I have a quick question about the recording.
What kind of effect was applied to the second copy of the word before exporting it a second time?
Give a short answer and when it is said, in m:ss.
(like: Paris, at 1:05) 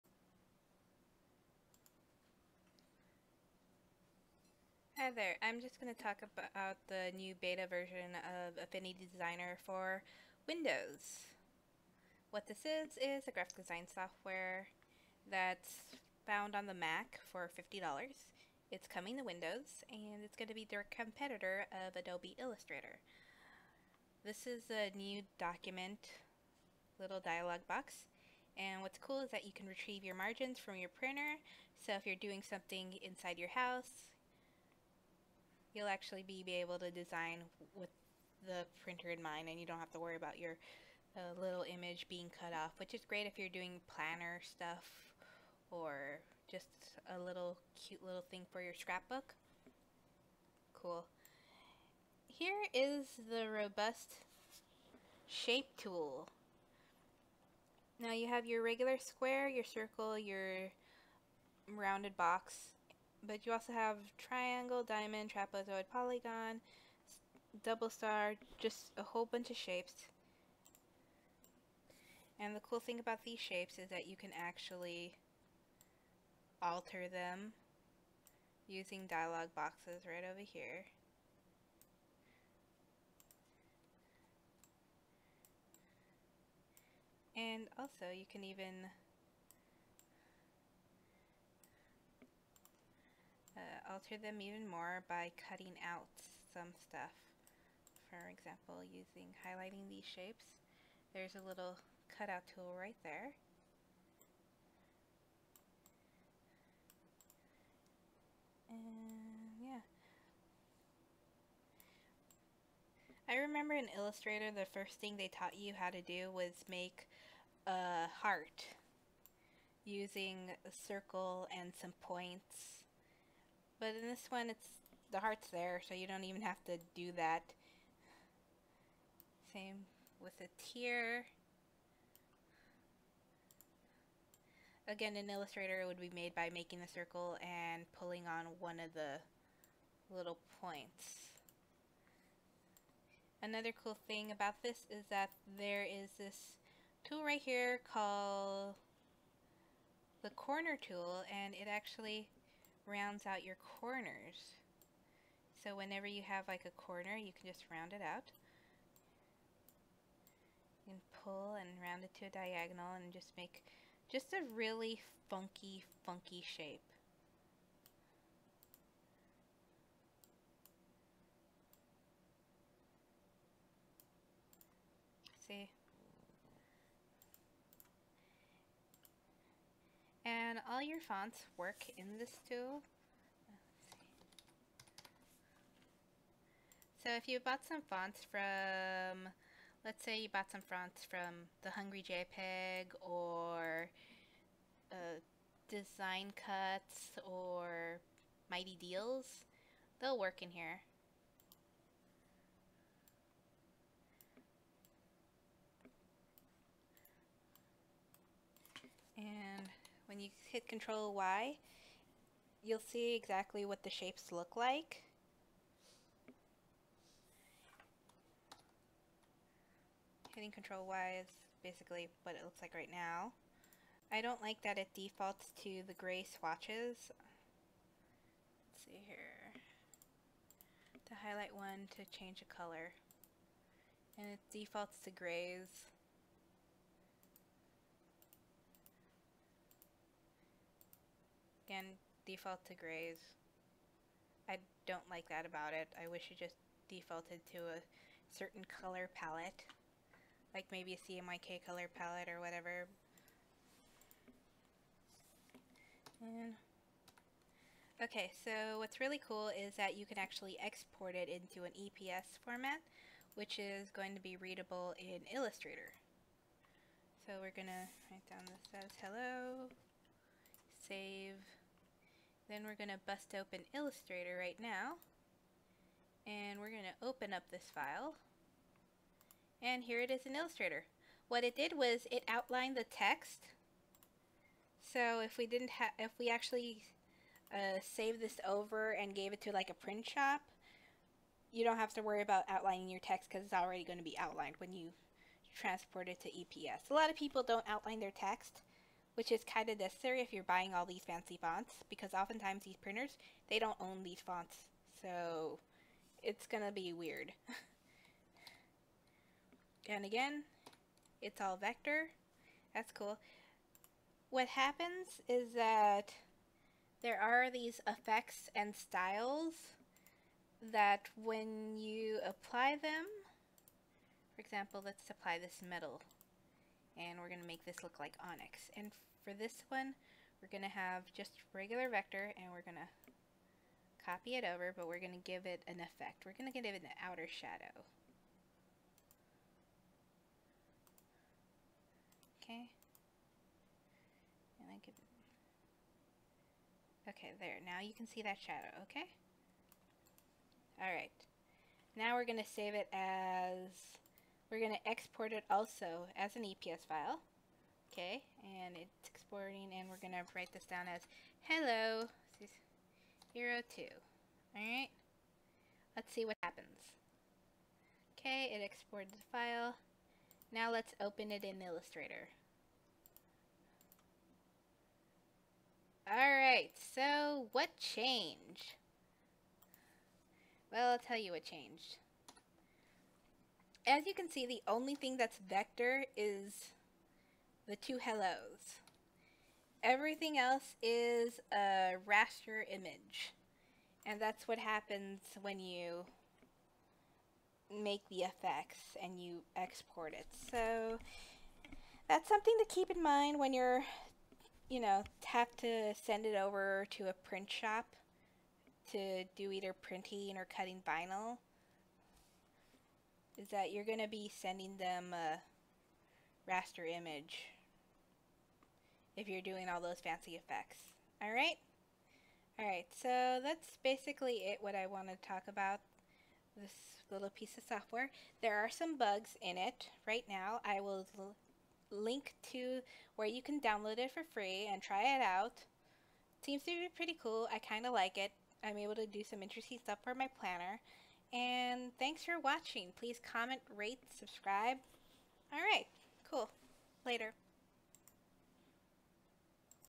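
outer shadow, at 5:36.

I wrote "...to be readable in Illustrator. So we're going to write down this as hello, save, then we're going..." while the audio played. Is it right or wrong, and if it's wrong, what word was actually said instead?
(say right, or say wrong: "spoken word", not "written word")
right.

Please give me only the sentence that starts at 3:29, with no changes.
And when you hit Control Y, you'll see exactly what the shapes look like.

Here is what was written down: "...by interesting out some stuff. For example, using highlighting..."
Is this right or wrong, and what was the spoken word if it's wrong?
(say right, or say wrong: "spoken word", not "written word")
wrong: "cutting", not "interesting".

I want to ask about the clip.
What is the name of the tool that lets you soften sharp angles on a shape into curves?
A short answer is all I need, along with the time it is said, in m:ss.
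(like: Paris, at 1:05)
corner tool, at 2:30.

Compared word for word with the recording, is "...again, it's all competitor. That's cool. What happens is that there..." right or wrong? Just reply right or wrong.
wrong.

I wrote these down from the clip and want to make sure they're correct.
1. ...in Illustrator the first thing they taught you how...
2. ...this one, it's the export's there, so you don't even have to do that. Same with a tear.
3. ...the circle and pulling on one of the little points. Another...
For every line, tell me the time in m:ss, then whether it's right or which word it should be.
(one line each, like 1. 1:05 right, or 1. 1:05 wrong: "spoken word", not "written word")
1. 1:53 right
2. 2:04 wrong: "heart", not "export"
3. 2:16 right.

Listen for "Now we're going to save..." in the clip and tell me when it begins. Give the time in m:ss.
5:51.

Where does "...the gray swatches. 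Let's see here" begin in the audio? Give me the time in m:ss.
3:45.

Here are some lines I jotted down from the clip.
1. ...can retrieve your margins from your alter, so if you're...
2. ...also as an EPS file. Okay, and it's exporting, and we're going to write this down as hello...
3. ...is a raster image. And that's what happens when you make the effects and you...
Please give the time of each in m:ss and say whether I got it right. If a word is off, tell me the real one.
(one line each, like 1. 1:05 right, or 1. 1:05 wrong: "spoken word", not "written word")
1. 0:29 wrong: "printer", not "alter"
2. 5:55 right
3. 6:30 right.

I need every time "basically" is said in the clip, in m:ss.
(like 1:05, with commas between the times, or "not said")
3:41, 7:03.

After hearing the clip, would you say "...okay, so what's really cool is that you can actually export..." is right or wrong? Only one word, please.
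right.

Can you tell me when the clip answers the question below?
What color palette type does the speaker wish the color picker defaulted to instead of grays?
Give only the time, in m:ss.
4:10.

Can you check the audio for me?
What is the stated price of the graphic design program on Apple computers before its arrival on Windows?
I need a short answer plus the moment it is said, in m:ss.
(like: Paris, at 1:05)
$50, at 0:17.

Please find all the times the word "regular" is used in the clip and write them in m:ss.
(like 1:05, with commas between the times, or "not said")
0:58, 5:31.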